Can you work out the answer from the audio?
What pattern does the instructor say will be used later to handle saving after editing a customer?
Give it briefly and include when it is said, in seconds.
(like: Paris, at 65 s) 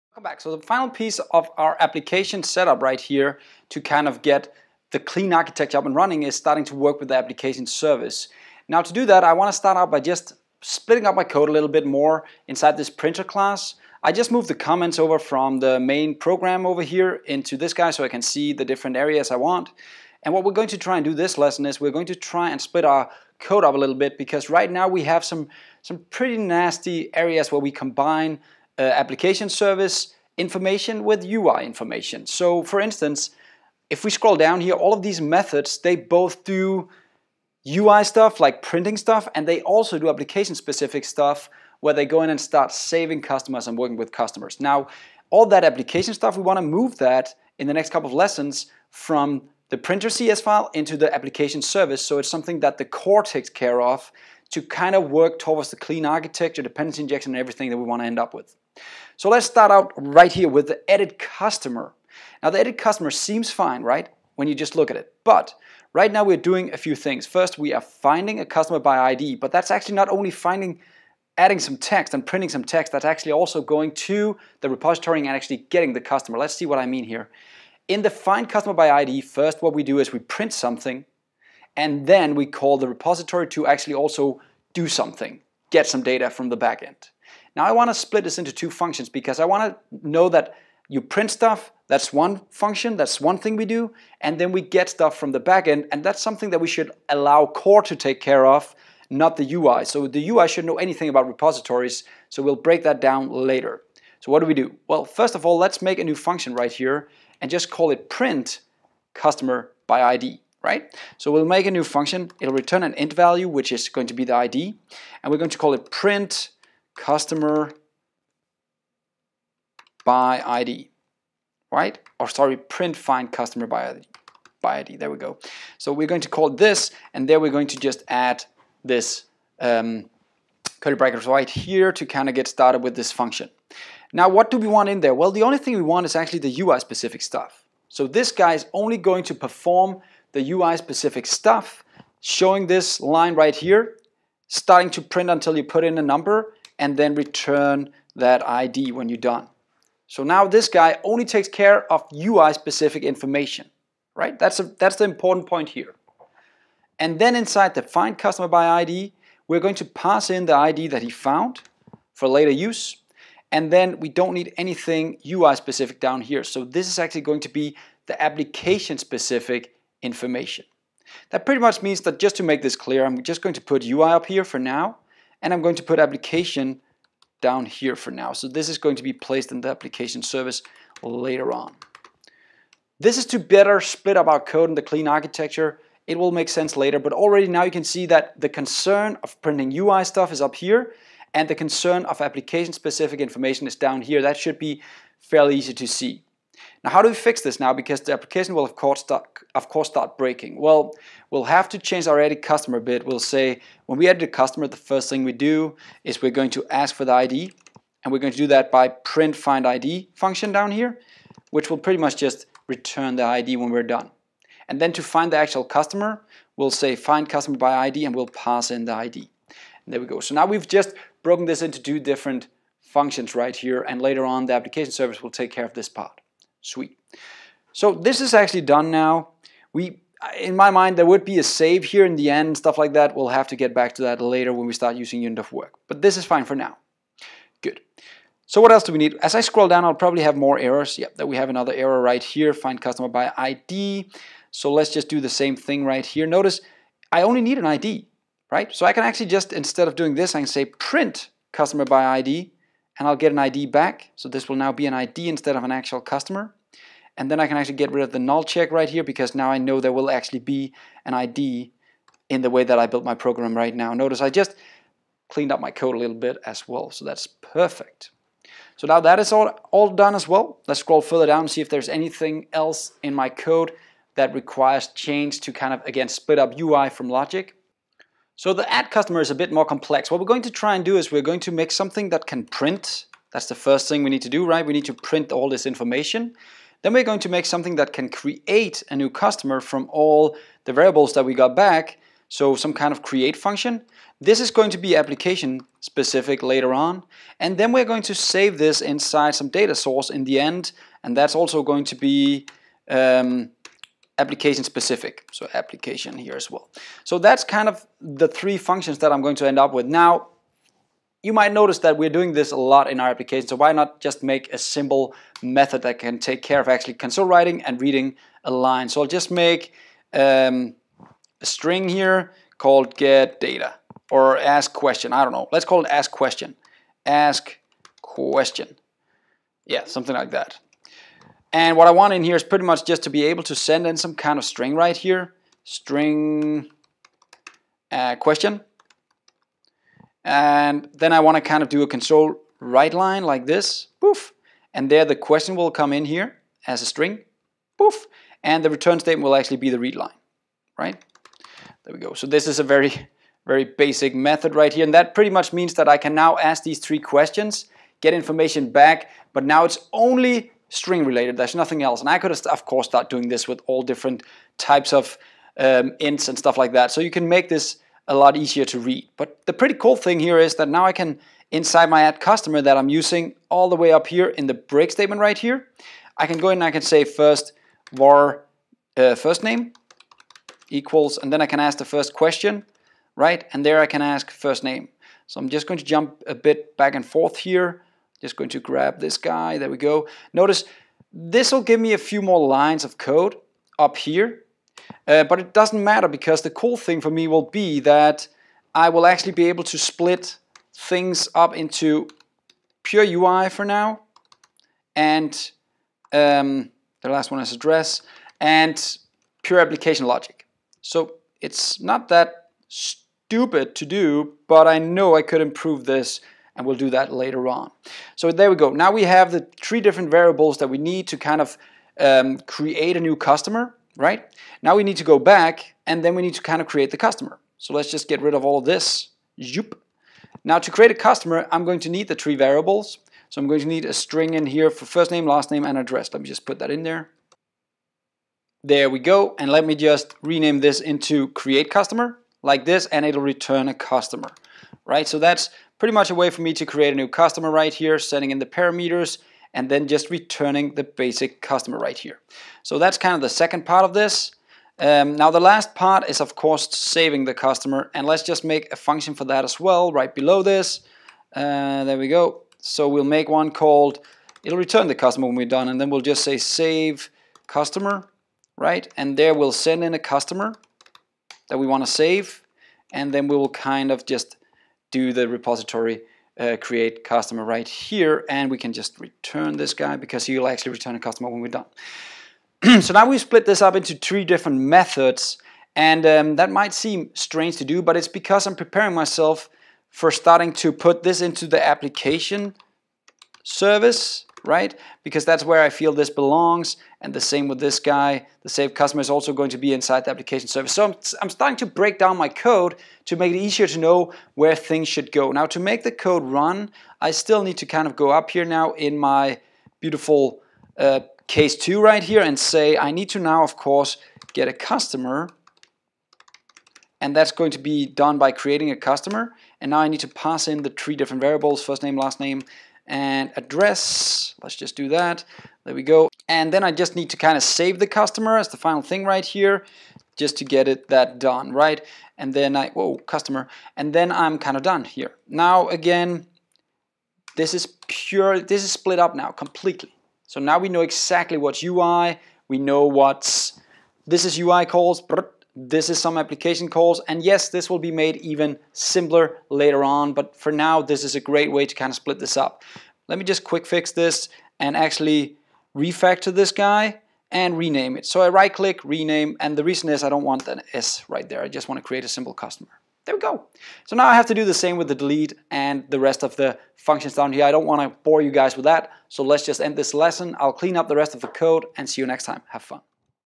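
unit of work, at 235 s.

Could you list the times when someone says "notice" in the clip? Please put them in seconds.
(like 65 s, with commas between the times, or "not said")
246 s, 263 s, 311 s, 390 s.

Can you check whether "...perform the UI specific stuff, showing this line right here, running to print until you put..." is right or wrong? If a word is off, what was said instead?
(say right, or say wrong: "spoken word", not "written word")
wrong: "starting", not "running".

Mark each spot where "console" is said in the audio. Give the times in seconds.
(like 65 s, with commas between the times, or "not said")
317 s, 341 s.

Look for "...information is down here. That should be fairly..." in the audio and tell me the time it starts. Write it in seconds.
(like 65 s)
193 s.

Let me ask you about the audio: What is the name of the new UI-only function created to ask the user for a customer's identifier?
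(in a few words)
print find customer by ID.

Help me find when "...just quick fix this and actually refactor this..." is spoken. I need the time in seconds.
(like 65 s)
553 s.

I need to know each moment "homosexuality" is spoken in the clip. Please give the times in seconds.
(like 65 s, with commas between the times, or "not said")
not said.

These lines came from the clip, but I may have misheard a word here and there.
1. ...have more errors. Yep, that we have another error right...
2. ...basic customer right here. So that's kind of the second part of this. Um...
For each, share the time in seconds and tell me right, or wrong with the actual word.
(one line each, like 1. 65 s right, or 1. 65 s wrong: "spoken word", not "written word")
1. 240 s right
2. 450 s right.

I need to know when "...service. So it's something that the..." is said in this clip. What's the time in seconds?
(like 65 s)
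51 s.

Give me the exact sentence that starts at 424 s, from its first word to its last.
Now we need to go back and then we need to kind of create the customer.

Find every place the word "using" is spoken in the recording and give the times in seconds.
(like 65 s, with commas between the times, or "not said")
234 s, 372 s.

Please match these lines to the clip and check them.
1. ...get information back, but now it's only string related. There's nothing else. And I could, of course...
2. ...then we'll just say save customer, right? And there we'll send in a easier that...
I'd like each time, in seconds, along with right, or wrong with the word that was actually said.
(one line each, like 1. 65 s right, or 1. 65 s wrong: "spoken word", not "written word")
1. 357 s right
2. 465 s wrong: "customer", not "easier".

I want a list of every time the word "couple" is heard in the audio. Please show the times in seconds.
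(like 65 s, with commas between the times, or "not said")
47 s.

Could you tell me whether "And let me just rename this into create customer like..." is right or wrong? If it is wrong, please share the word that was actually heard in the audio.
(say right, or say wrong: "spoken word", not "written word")
right.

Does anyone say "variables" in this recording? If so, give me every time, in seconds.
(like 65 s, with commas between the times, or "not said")
290 s, 420 s, 432 s, 521 s.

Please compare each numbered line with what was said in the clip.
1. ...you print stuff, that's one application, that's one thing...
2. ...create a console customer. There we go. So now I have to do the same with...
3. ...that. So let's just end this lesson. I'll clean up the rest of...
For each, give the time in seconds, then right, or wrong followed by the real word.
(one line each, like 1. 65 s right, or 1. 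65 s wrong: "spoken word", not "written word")
1. 90 s wrong: "function", not "application"
2. 561 s wrong: "simple", not "console"
3. 568 s right.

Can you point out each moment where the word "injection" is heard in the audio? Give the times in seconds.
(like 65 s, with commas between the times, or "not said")
57 s.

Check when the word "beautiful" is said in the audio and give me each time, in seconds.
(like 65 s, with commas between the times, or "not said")
509 s.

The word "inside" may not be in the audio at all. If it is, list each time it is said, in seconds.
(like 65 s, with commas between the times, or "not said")
12 s, 157 s, 298 s, 371 s, 499 s.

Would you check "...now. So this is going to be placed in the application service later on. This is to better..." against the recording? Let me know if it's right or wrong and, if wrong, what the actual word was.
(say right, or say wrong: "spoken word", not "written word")
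right.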